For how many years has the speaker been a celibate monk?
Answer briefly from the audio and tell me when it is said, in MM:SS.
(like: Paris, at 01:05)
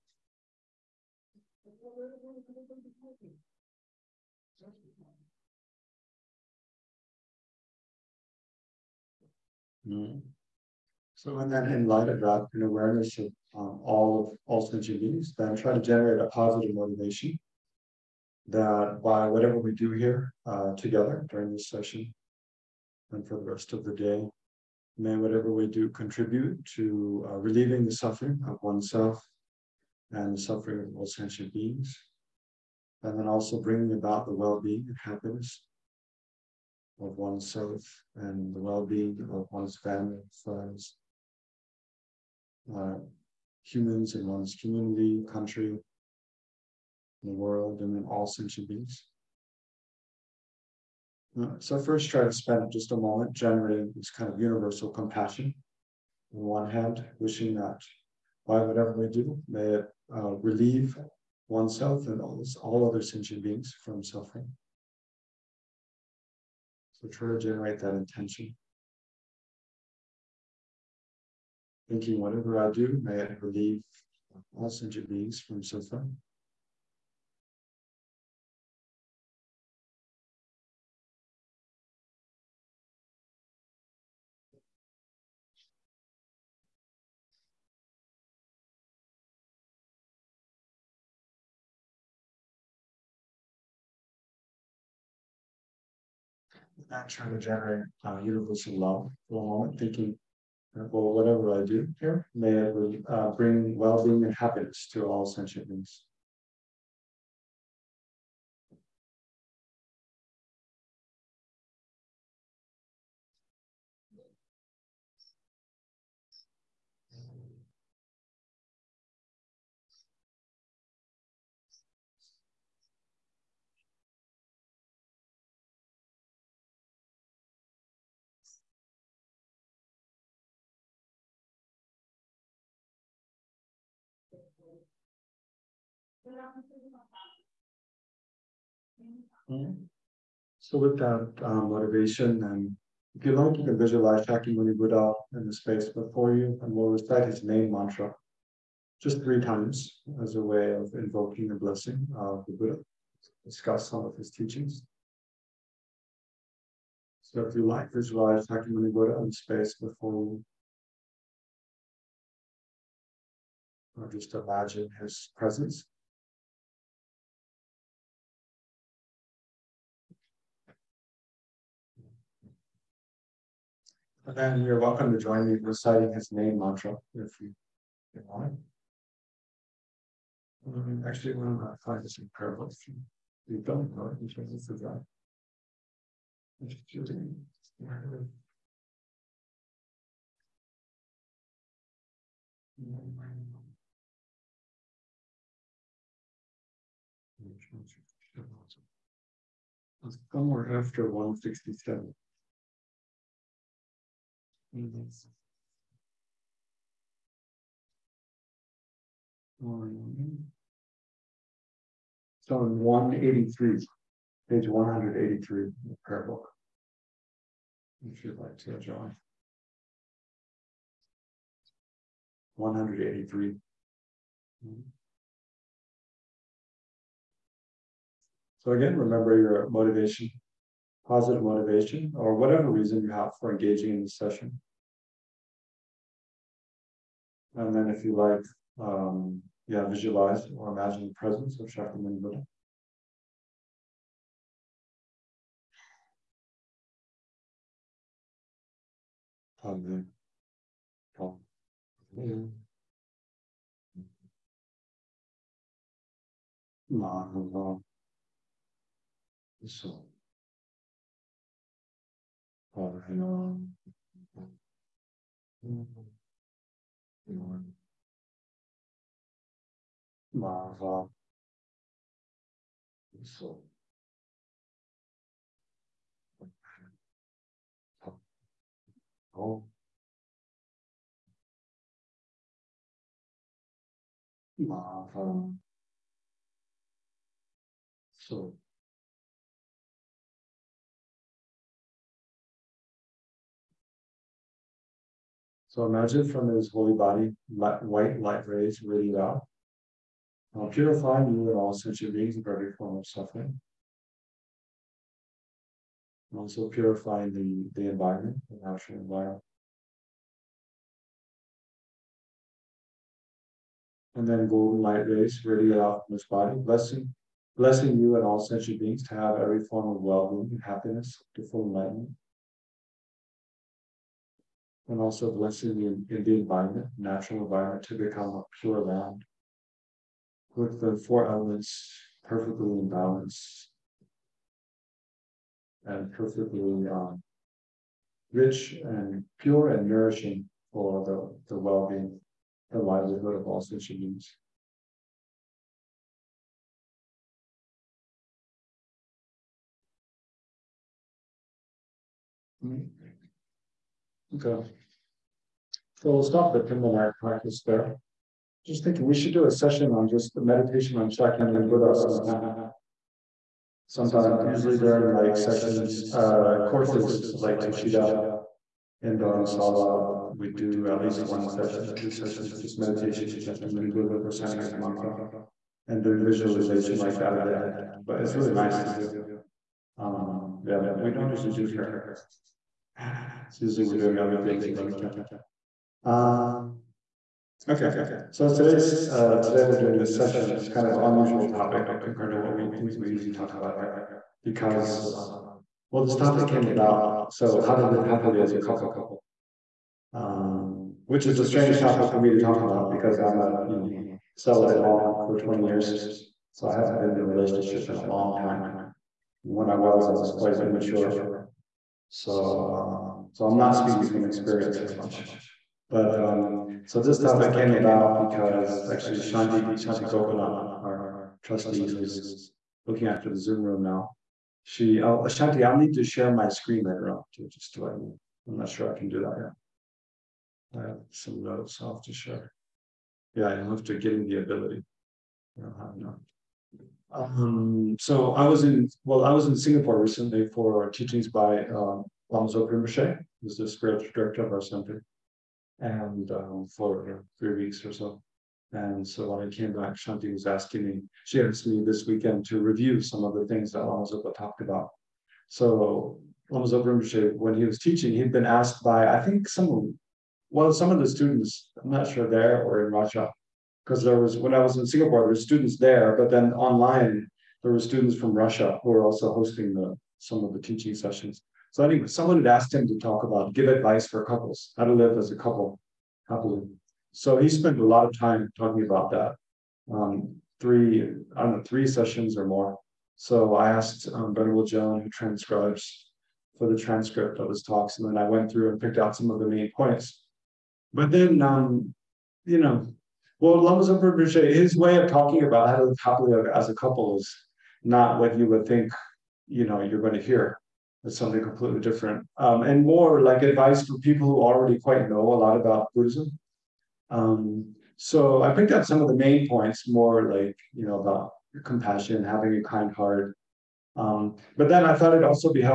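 20, at 06:45.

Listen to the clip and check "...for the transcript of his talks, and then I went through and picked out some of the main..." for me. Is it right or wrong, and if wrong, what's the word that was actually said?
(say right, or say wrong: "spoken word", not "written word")
right.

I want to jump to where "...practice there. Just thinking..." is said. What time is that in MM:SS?
05:57.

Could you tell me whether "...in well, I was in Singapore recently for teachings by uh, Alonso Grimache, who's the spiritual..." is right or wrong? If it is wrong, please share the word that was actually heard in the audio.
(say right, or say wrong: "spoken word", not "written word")
right.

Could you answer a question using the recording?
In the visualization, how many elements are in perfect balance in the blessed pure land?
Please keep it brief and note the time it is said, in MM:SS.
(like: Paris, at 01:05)
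4, at 05:31.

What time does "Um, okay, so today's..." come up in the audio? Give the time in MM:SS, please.
06:26.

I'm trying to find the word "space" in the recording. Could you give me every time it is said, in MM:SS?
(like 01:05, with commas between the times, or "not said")
02:25, 02:39.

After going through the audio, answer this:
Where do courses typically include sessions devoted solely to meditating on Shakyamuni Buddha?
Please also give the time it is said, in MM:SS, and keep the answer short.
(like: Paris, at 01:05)
Dharamsala, at 06:09.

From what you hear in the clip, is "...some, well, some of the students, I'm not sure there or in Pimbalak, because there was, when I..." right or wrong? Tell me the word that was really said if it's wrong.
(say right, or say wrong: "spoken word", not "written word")
wrong: "Russia", not "Pimbalak".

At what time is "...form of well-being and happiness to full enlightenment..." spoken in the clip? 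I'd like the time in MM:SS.
05:19.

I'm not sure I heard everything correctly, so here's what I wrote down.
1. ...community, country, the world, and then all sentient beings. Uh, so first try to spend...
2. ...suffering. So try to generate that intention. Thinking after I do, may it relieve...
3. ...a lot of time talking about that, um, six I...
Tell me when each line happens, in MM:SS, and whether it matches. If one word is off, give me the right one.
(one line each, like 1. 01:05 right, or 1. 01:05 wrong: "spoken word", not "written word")
1. 00:44 right
2. 01:04 wrong: "whatever", not "after"
3. 07:57 wrong: "three", not "six".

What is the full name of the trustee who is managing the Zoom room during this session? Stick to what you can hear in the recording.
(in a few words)
Shanti Gopinath.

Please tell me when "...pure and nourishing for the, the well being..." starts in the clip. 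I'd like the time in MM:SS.
05:39.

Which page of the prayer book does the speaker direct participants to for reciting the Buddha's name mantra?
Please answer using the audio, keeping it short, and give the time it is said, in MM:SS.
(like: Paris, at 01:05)
183, at 03:34.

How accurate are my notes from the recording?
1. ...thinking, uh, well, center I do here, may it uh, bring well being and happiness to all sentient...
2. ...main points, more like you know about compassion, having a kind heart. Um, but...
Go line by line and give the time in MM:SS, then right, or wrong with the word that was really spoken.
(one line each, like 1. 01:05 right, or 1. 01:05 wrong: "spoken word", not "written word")
1. 01:39 wrong: "whatever", not "center"
2. 08:29 right.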